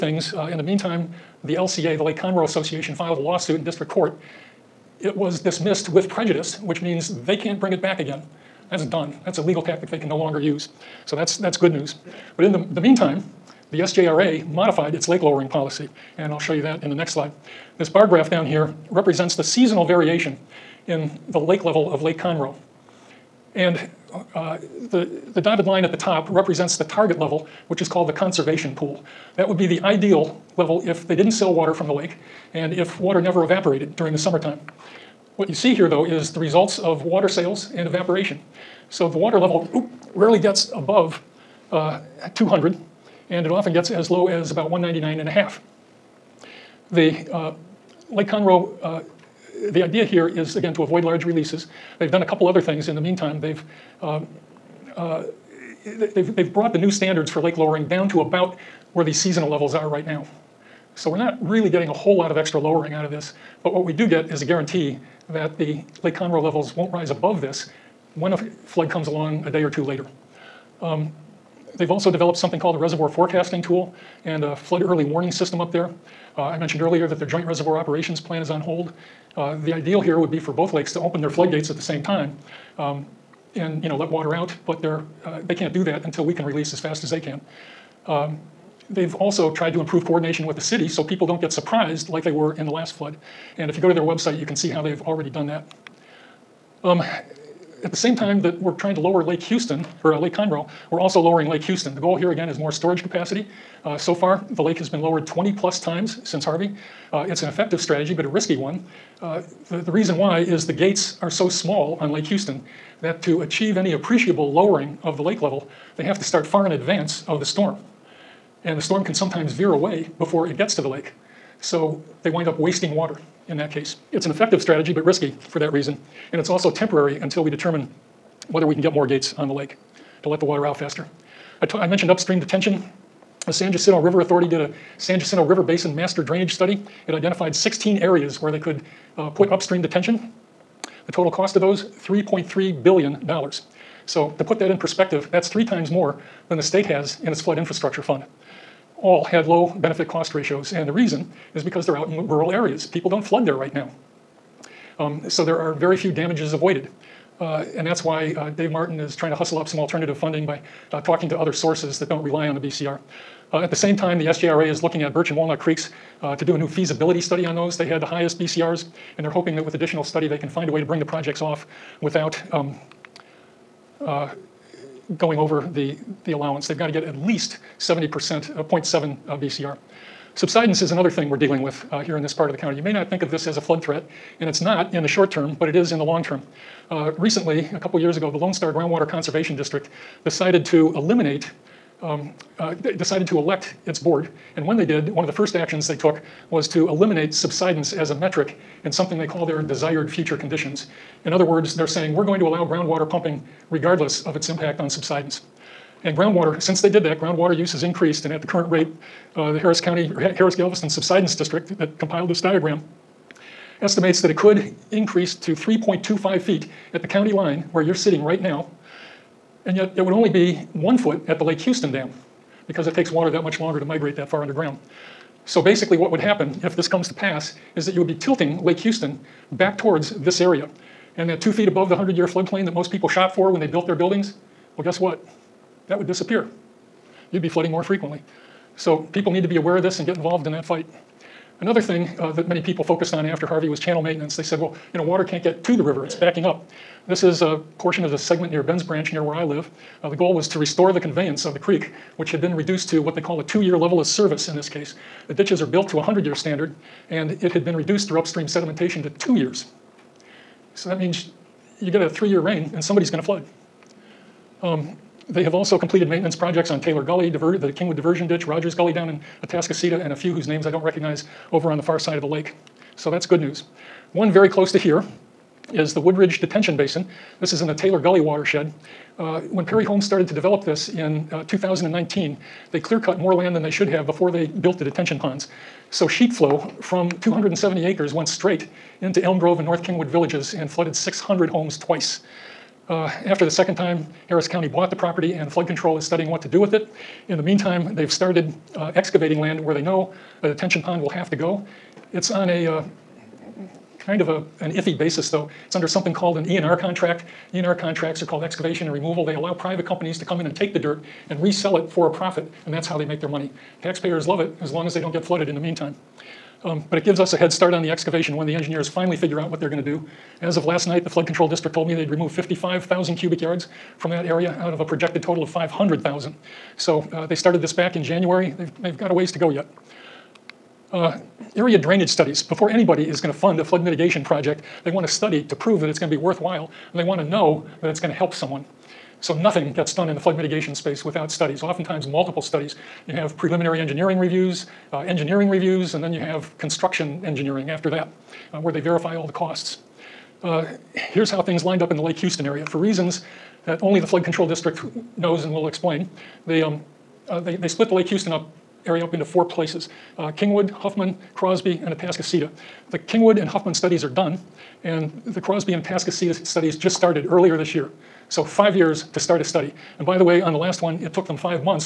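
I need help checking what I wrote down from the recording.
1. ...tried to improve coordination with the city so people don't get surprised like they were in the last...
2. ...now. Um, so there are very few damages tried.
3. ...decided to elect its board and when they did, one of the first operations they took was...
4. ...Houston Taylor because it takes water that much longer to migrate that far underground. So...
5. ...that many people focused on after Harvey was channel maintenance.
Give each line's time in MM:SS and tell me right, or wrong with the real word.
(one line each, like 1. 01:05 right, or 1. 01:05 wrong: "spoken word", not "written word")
1. 01:29 right
2. 02:33 wrong: "avoided", not "tried"
3. 03:12 wrong: "actions", not "operations"
4. 03:41 wrong: "Dam", not "Taylor"
5. 04:02 right.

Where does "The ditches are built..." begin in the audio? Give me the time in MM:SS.
04:15.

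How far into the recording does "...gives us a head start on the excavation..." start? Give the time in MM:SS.
05:17.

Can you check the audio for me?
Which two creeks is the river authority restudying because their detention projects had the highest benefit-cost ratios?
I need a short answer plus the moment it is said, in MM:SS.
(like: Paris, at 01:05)
Birch and Walnut Creeks, at 02:45.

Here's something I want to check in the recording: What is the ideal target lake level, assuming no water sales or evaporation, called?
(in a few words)
conservation pool.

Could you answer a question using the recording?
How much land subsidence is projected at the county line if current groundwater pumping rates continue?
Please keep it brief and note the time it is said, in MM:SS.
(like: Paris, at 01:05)
3.25 feet, at 03:35.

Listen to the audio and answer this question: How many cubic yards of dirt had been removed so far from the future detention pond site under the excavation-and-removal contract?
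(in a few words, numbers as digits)
55,000.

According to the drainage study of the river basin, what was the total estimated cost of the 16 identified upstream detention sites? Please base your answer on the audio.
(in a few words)
$3.3 billion.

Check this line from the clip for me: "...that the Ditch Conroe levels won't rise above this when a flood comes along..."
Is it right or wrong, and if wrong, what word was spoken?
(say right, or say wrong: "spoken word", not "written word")
wrong: "Lake", not "Ditch".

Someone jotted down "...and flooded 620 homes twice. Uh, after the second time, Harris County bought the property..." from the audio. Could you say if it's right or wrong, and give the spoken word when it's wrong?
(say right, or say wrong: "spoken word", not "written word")
wrong: "600", not "620".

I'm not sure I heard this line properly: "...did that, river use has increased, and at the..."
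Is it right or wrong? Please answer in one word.
wrong.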